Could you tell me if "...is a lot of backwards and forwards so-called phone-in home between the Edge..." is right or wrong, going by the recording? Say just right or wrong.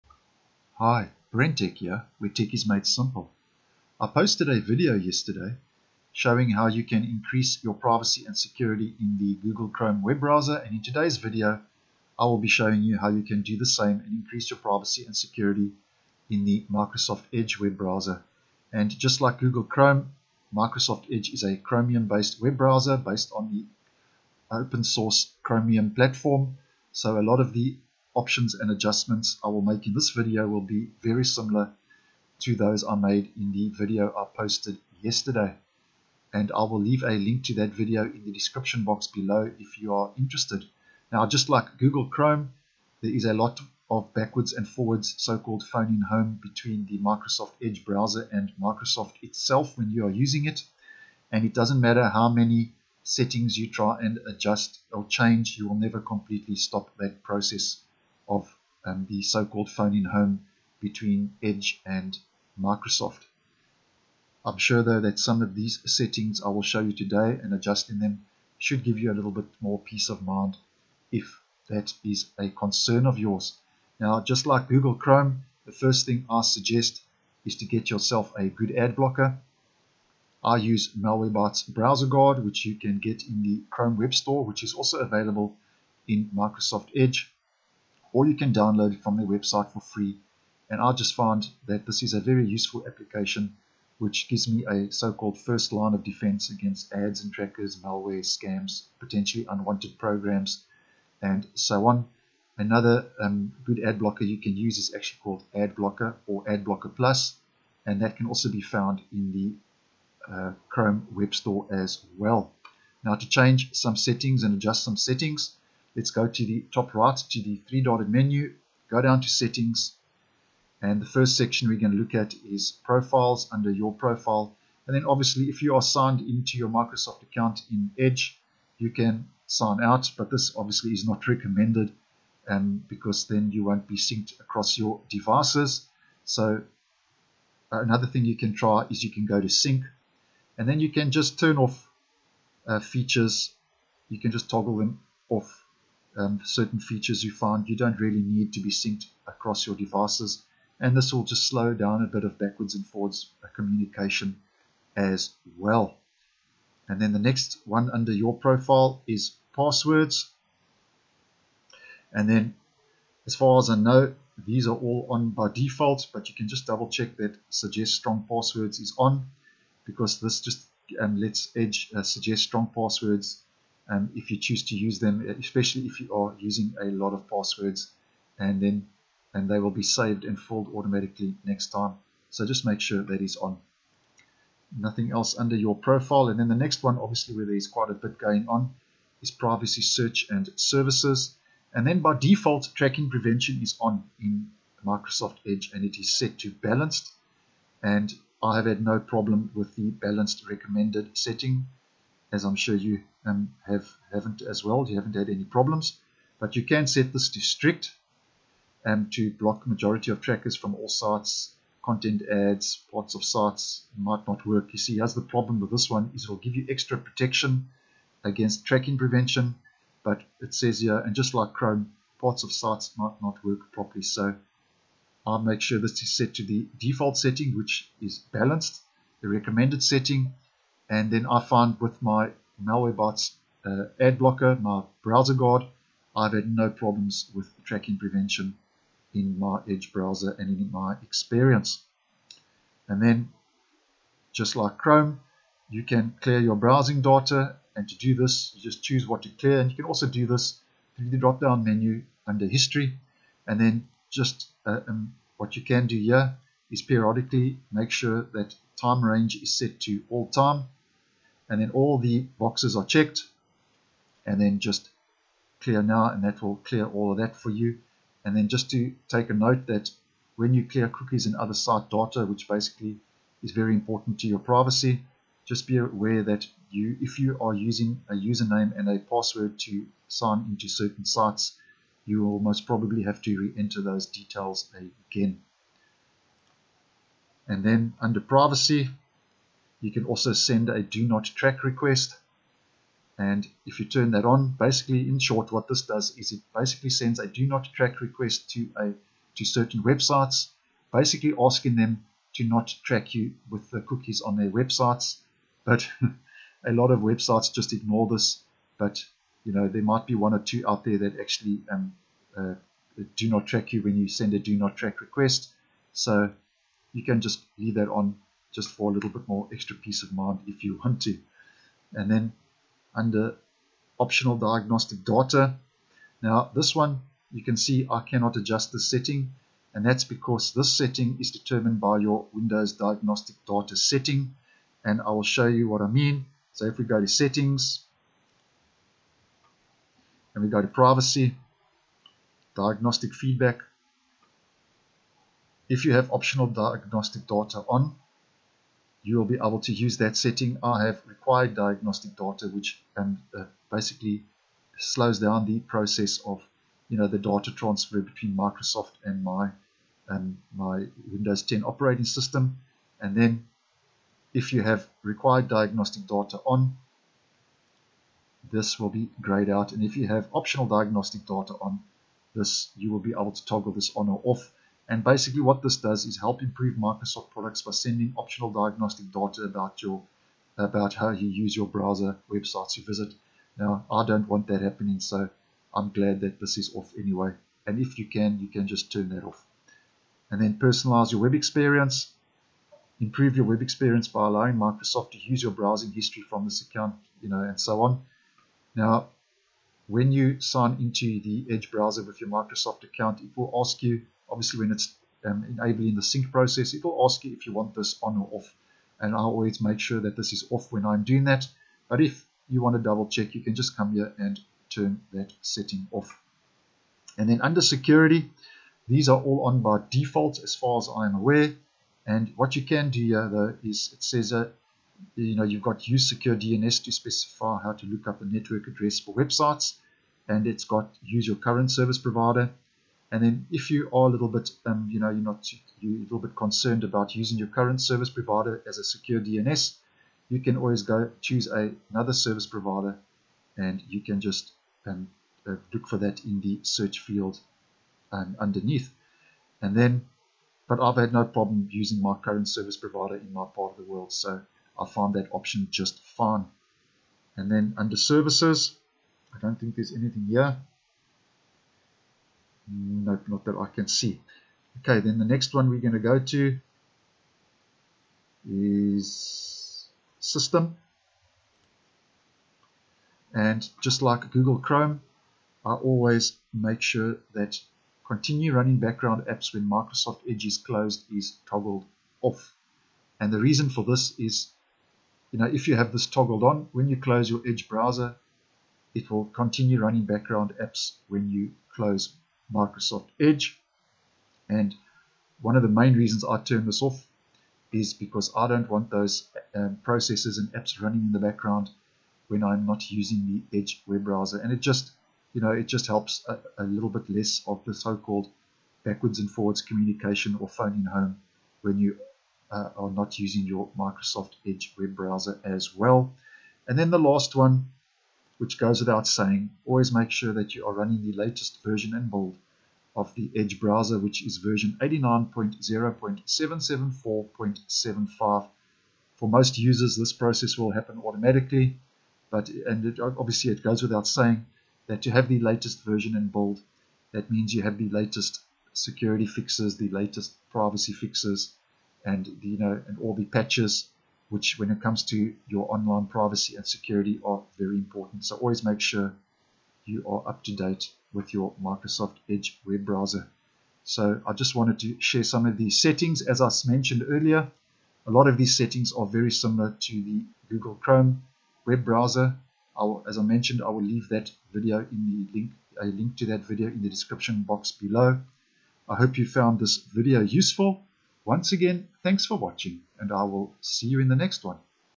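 wrong.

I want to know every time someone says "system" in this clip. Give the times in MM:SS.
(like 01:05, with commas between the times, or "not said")
06:02, 07:50.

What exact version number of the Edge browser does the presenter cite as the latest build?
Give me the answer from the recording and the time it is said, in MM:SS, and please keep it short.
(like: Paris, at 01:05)
89.0.774.75, at 08:44.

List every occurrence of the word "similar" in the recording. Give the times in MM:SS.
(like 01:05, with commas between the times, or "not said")
00:31, 09:19.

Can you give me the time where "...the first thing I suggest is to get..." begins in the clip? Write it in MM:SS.
01:15.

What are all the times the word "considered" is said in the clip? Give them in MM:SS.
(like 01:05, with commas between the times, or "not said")
not said.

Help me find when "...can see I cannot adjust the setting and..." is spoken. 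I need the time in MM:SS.
05:27.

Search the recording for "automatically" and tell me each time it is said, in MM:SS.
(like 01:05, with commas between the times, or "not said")
03:00, 08:51.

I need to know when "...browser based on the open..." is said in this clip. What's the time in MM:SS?
00:22.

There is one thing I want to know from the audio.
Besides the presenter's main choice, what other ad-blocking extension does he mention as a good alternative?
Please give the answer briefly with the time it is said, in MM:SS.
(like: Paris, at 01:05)
Ad Blocker Plus, at 01:46.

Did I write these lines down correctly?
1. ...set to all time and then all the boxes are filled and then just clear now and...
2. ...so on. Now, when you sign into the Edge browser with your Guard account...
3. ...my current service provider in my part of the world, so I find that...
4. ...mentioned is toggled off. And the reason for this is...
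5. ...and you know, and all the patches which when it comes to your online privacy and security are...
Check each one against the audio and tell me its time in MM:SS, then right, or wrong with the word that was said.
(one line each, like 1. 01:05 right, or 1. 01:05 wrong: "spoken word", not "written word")
1. 04:19 wrong: "checked", not "filled"
2. 06:37 wrong: "Microsoft", not "Guard"
3. 07:32 right
4. 08:00 wrong: "closed", not "mentioned"
5. 09:02 right.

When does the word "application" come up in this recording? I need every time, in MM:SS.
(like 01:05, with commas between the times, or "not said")
01:32.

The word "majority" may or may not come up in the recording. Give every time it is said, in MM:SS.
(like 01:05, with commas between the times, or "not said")
03:29.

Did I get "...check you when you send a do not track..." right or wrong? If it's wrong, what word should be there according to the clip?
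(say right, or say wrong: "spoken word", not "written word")
wrong: "track", not "check".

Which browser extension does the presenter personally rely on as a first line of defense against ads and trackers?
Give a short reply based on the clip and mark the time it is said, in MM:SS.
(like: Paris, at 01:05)
Malwarebytes Browser Guard, at 01:20.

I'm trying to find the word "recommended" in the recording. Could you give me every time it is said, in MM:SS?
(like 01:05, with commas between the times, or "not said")
02:11, 03:20, 03:49.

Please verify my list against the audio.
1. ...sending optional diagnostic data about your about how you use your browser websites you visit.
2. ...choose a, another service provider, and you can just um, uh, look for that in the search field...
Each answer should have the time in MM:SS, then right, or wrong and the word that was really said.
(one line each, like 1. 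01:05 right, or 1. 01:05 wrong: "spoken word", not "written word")
1. 06:17 right
2. 07:21 right.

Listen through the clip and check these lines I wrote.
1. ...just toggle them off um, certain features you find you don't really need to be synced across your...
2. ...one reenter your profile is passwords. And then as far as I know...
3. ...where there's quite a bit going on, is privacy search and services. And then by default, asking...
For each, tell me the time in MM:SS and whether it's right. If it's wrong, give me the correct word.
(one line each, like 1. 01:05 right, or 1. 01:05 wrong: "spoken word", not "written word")
1. 02:24 right
2. 02:37 wrong: "under", not "reenter"
3. 03:07 wrong: "tracking", not "asking".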